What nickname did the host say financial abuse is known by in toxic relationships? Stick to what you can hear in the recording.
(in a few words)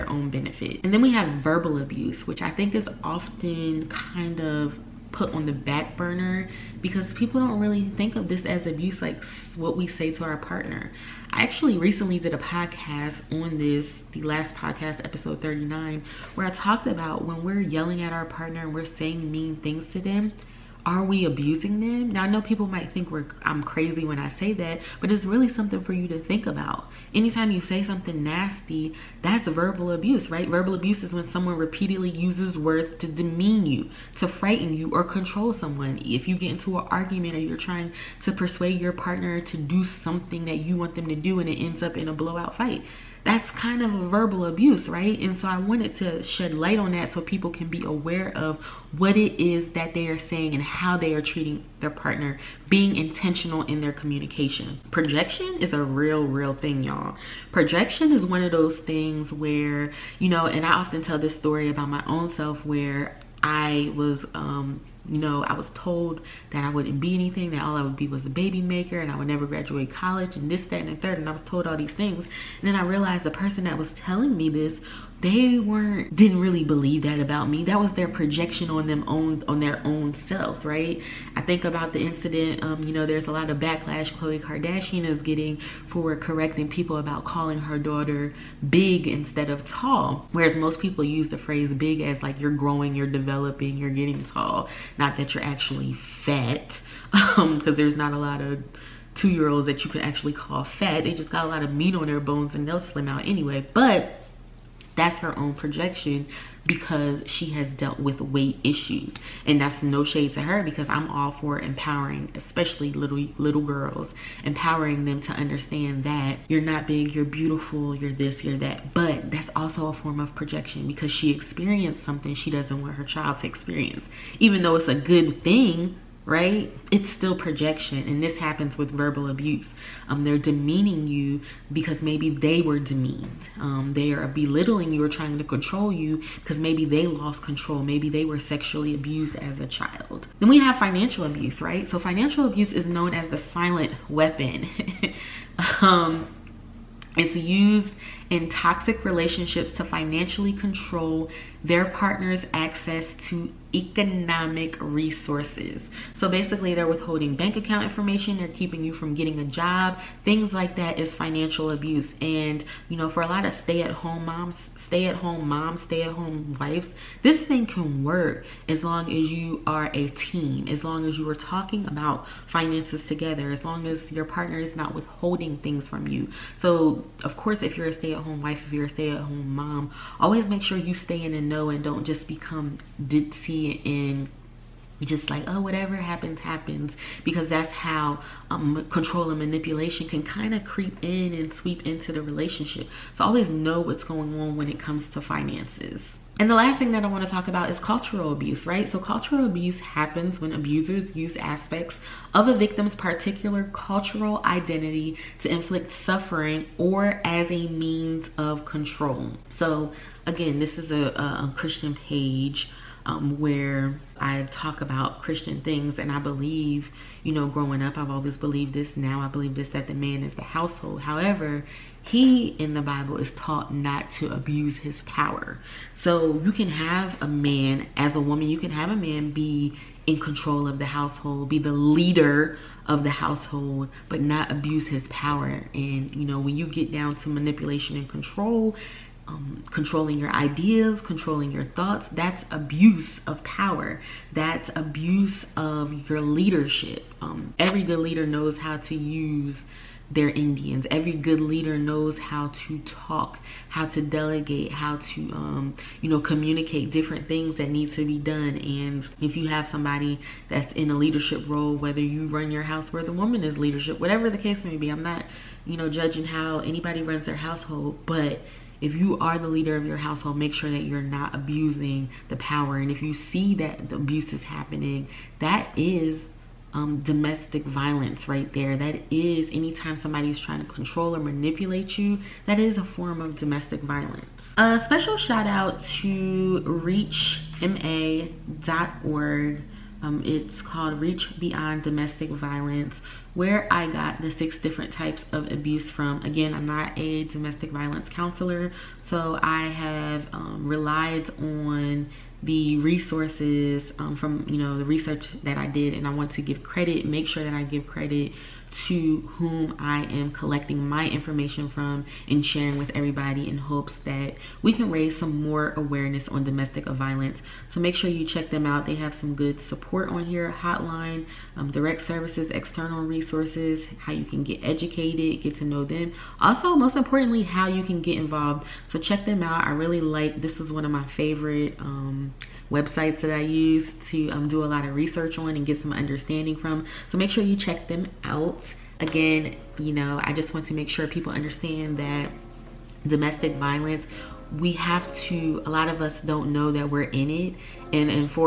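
The silent weapon.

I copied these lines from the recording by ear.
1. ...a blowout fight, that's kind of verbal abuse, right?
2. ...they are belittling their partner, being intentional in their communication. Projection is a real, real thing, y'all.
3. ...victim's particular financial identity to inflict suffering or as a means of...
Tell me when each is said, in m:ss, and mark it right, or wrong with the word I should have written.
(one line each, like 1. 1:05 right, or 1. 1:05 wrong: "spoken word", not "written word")
1. 0:42 right
2. 0:50 wrong: "treating", not "belittling"
3. 3:22 wrong: "cultural", not "financial".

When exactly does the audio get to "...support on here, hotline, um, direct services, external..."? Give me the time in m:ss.
5:19.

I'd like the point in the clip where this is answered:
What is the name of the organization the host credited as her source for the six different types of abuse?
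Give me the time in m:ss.
4:51.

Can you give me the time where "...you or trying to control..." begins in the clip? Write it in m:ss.
2:14.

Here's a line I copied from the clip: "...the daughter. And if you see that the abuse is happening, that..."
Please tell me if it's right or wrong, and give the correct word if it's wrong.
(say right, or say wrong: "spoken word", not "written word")
wrong: "power", not "daughter".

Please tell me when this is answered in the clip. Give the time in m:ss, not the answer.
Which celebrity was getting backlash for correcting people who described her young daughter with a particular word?
1:24.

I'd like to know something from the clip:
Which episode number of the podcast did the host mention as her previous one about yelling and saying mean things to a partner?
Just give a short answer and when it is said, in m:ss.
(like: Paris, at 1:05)
39, at 0:15.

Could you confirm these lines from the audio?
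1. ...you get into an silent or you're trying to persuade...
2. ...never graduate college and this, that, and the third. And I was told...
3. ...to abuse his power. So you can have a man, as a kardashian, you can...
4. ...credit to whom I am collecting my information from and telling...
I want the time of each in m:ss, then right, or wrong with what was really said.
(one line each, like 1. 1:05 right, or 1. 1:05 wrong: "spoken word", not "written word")
1. 0:36 wrong: "argument", not "silent"
2. 1:09 right
3. 3:44 wrong: "woman", not "kardashian"
4. 5:07 wrong: "sharing", not "telling".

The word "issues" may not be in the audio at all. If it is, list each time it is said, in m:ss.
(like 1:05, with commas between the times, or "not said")
1:48.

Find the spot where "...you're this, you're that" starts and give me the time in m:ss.
1:57.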